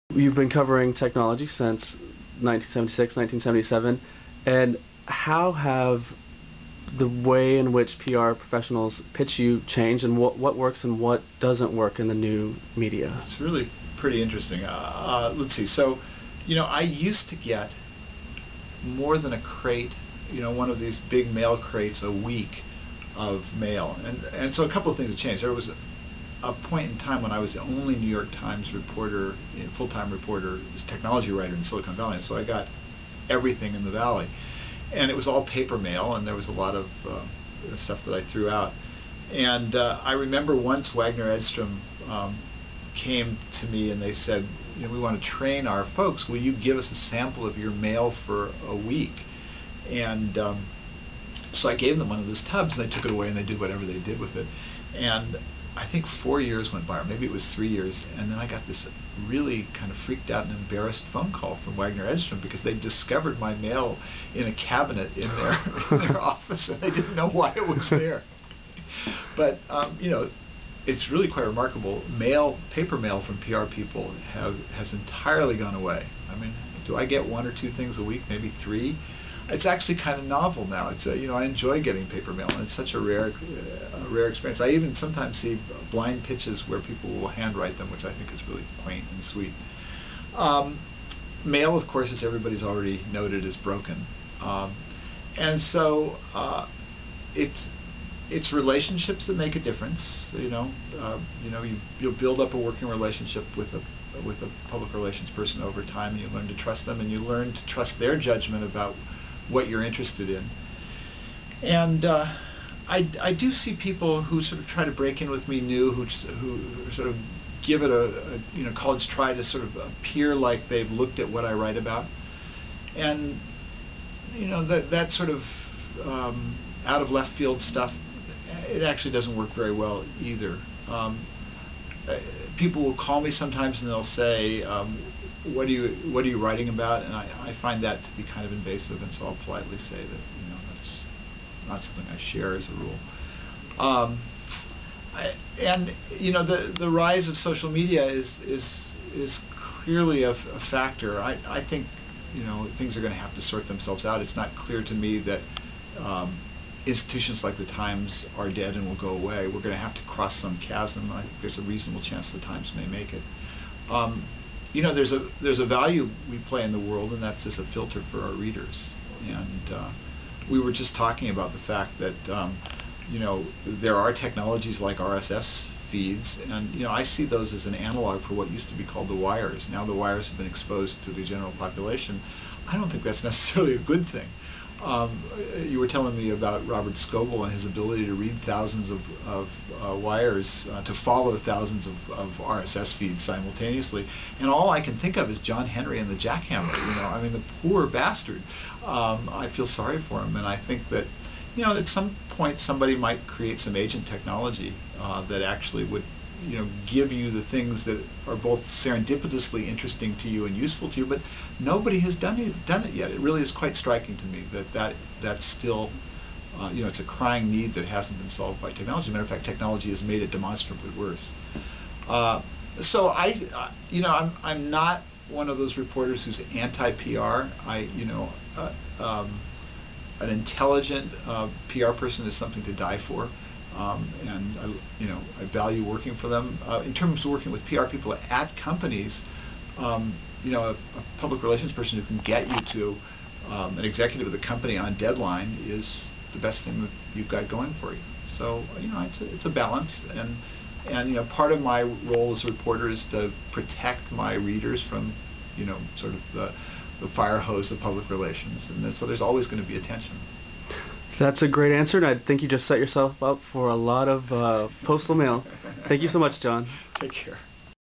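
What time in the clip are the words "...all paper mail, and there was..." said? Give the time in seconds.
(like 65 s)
35 s.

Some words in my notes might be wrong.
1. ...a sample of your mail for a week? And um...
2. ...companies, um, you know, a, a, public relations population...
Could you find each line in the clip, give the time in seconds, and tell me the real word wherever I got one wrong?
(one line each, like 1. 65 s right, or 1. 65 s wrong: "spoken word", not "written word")
1. 46 s right
2. 238 s wrong: "person", not "population".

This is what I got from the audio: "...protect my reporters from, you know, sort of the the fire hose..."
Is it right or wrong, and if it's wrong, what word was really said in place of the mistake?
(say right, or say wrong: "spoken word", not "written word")
wrong: "readers", not "reporters".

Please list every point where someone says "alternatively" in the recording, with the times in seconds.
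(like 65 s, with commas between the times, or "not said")
not said.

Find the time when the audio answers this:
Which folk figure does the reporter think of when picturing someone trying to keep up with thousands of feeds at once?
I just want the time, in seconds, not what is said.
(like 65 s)
195 s.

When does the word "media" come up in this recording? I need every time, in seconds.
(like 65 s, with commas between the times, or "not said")
12 s, 147 s.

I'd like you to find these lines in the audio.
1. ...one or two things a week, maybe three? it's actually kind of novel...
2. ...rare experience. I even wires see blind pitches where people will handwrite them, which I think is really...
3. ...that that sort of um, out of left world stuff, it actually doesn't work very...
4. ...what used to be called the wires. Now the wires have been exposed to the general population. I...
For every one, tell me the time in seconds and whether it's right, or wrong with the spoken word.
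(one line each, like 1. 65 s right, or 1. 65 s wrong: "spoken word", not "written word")
1. 77 s right
2. 84 s wrong: "sometimes", not "wires"
3. 124 s wrong: "field", not "world"
4. 178 s right.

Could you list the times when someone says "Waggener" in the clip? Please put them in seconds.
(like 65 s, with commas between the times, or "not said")
40 s, 61 s.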